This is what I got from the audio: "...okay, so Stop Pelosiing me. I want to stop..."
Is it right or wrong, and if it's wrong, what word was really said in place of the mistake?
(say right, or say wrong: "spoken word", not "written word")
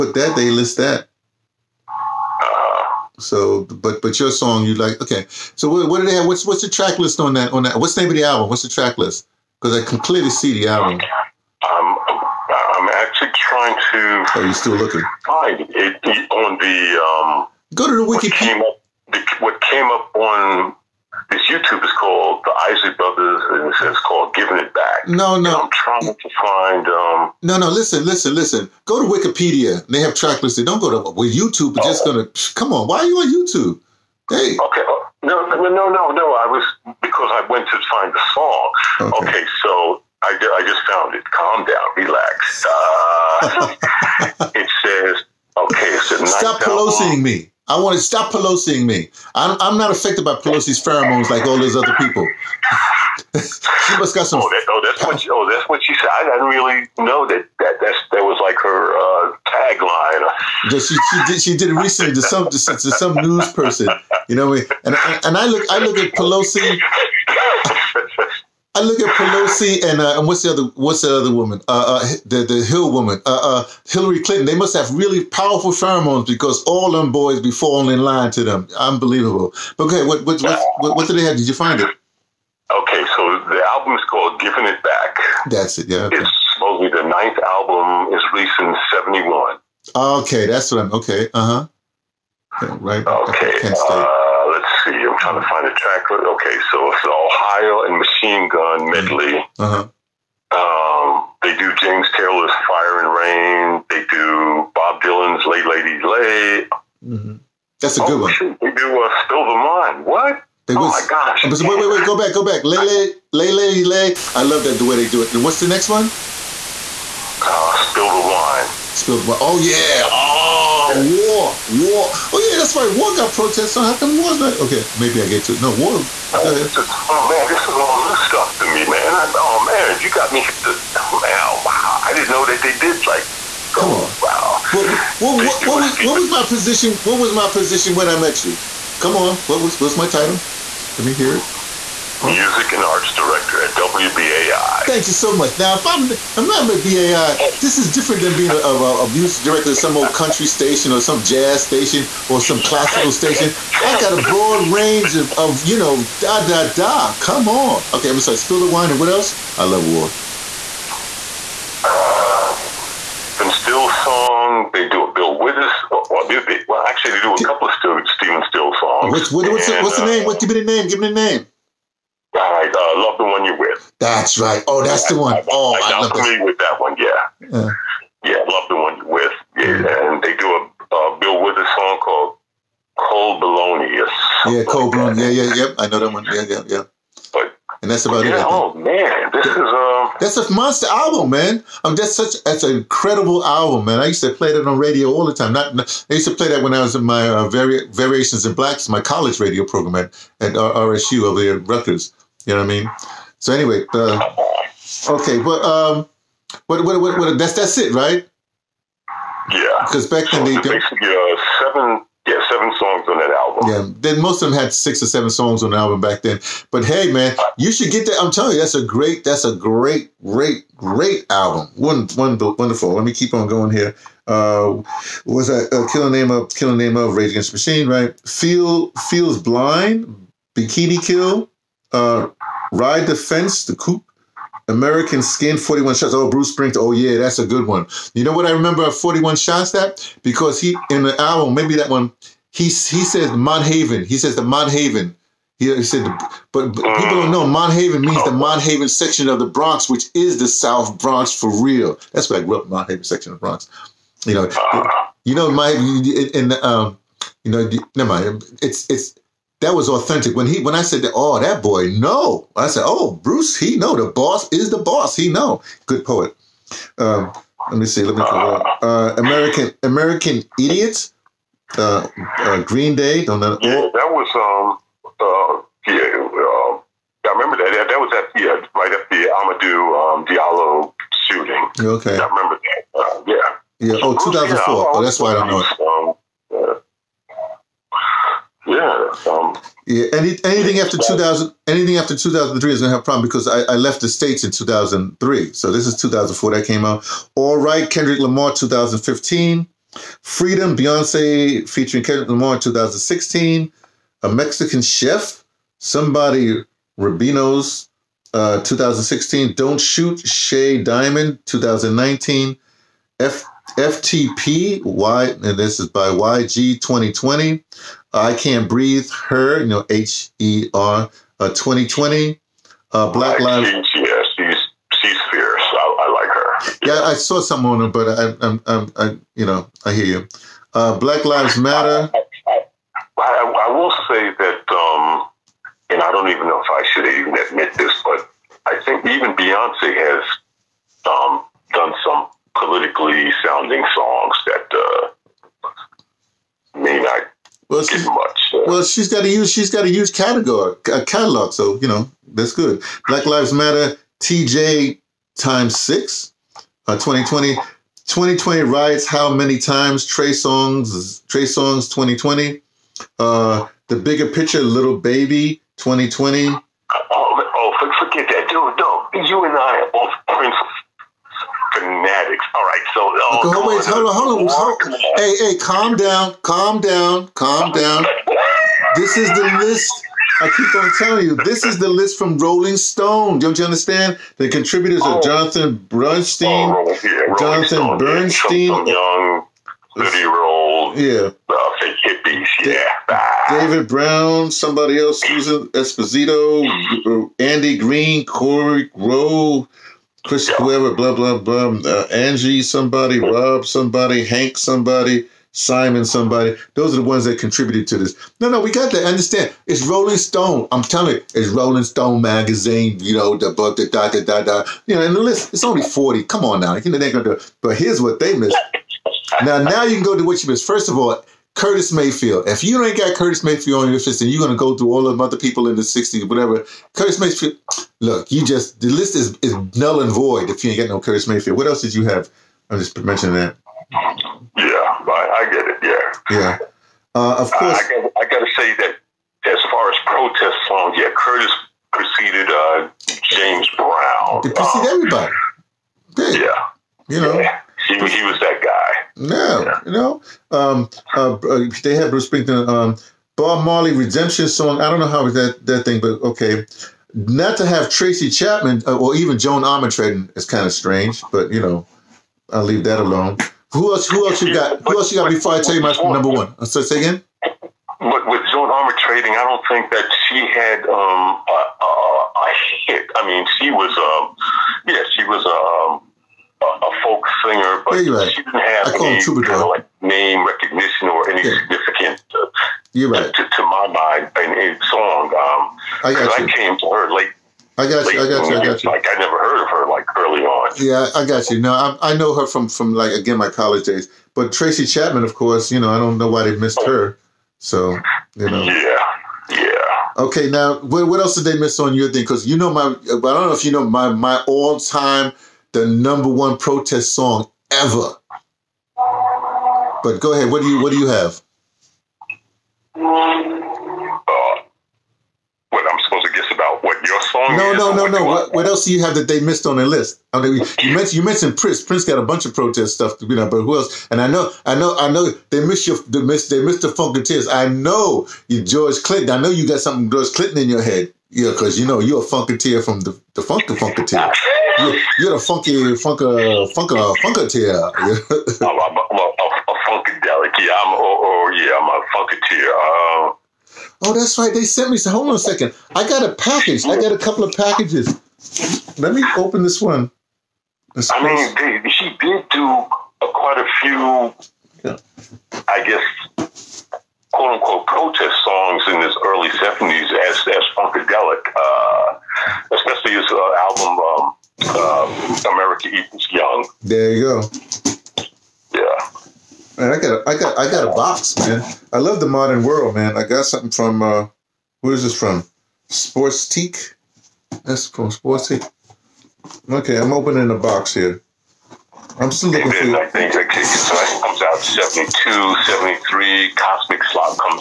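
right.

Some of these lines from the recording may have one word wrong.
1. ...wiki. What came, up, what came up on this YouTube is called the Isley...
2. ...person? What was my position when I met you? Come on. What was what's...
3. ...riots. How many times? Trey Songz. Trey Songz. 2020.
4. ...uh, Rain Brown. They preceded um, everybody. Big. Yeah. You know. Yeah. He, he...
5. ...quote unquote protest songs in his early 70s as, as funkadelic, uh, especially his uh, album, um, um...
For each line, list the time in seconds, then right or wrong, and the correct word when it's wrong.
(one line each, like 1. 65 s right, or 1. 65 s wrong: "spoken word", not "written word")
1. 18 s right
2. 136 s wrong: "position", not "person"
3. 358 s right
4. 442 s wrong: "James", not "Rain"
5. 557 s right.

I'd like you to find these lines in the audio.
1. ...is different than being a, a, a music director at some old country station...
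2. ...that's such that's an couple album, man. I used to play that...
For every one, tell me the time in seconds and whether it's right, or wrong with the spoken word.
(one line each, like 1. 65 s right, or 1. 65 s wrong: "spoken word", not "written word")
1. 147 s right
2. 191 s wrong: "incredible", not "couple".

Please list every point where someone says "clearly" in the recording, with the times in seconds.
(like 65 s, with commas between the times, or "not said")
9 s.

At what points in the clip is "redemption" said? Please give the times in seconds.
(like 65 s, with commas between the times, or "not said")
453 s.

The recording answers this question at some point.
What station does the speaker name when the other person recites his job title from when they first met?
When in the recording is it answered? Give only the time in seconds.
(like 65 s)
143 s.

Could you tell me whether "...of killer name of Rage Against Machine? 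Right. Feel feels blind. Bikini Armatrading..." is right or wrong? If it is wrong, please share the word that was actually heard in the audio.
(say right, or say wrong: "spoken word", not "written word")
wrong: "Kill", not "Armatrading".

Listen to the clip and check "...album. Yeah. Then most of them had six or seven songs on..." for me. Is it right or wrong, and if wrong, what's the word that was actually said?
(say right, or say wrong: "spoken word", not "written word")
right.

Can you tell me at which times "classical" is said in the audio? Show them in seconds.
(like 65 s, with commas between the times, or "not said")
152 s.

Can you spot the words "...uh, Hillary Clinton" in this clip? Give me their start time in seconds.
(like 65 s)
73 s.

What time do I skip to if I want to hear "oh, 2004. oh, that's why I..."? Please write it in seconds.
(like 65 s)
284 s.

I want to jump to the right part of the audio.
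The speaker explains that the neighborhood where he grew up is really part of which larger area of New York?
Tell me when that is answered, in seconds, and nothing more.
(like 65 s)
250 s.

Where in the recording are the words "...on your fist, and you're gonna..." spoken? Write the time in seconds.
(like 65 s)
423 s.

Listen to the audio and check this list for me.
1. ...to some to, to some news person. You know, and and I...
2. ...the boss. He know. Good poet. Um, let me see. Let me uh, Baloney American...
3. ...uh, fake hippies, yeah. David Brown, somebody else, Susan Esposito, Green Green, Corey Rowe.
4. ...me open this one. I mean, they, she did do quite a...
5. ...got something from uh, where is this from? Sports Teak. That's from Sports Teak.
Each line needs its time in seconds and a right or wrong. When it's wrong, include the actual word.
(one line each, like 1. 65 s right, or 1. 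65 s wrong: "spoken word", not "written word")
1. 62 s right
2. 264 s wrong: "American", not "Baloney"
3. 391 s wrong: "Andy", not "Green"
4. 549 s right
5. 573 s right.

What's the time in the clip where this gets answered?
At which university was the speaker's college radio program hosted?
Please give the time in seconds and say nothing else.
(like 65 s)
201 s.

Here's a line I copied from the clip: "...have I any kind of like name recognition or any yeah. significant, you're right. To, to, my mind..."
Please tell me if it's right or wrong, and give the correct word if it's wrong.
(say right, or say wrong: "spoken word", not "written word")
right.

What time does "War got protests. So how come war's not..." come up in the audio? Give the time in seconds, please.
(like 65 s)
122 s.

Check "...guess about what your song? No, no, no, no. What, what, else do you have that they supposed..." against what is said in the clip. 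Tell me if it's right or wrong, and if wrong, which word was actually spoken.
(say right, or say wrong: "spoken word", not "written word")
wrong: "missed", not "supposed".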